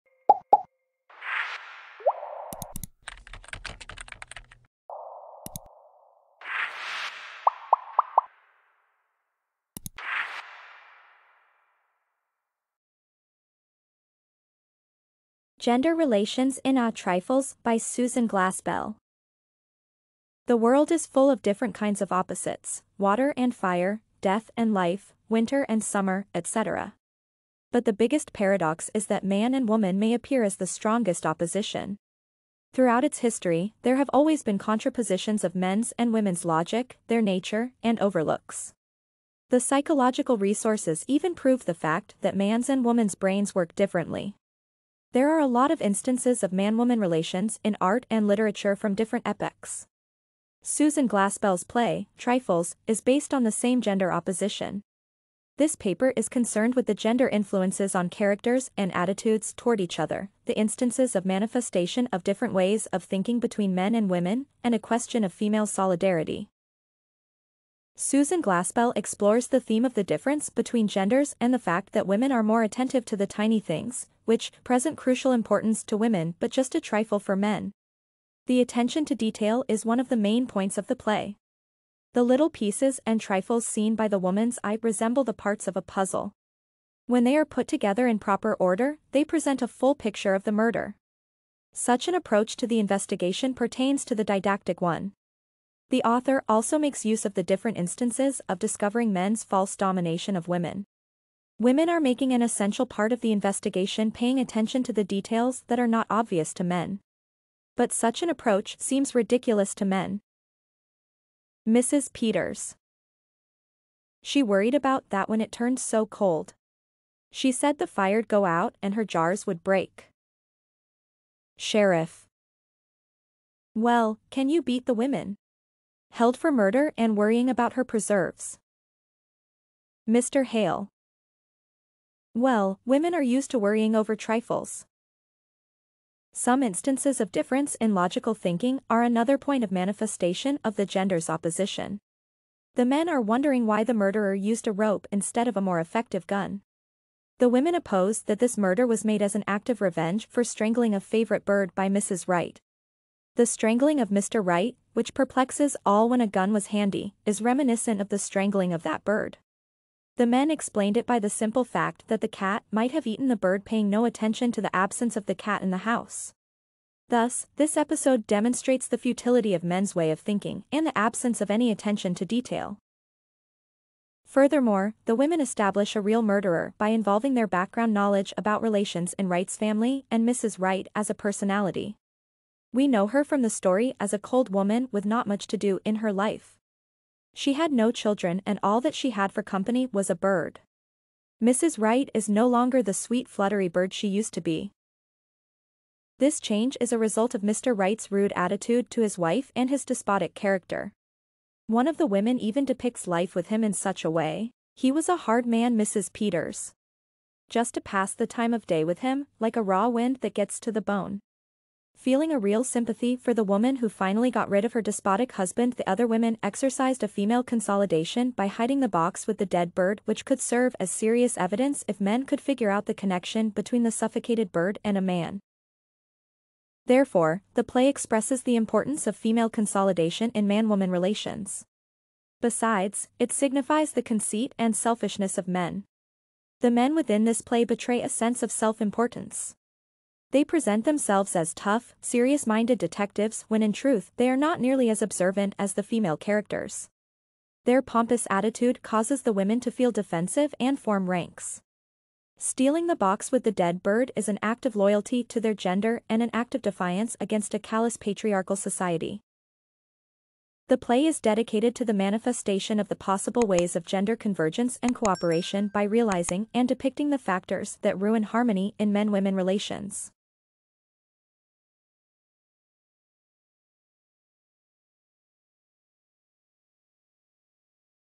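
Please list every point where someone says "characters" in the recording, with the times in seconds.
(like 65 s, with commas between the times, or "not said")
58 s, 200 s, 246 s.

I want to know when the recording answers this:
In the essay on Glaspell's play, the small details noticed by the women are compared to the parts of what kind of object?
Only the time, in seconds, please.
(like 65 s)
85 s.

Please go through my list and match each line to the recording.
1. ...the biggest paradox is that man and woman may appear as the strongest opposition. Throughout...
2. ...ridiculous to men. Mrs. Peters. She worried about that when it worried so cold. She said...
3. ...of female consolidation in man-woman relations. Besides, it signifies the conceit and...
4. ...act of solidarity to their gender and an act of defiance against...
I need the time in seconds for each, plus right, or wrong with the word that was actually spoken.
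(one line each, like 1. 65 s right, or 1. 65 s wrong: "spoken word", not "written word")
1. 27 s right
2. 109 s wrong: "turned", not "worried"
3. 229 s right
4. 254 s wrong: "loyalty", not "solidarity".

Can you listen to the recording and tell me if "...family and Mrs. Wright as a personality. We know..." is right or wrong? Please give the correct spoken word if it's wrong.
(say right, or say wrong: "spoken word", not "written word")
right.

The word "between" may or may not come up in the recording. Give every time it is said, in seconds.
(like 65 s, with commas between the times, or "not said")
63 s, 70 s, 223 s.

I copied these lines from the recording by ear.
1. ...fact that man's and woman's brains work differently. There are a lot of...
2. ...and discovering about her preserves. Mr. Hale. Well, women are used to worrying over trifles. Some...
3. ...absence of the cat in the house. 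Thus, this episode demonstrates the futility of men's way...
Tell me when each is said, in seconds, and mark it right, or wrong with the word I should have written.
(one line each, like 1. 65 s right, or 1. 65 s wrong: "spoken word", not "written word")
1. 41 s right
2. 126 s wrong: "worrying", not "discovering"
3. 164 s right.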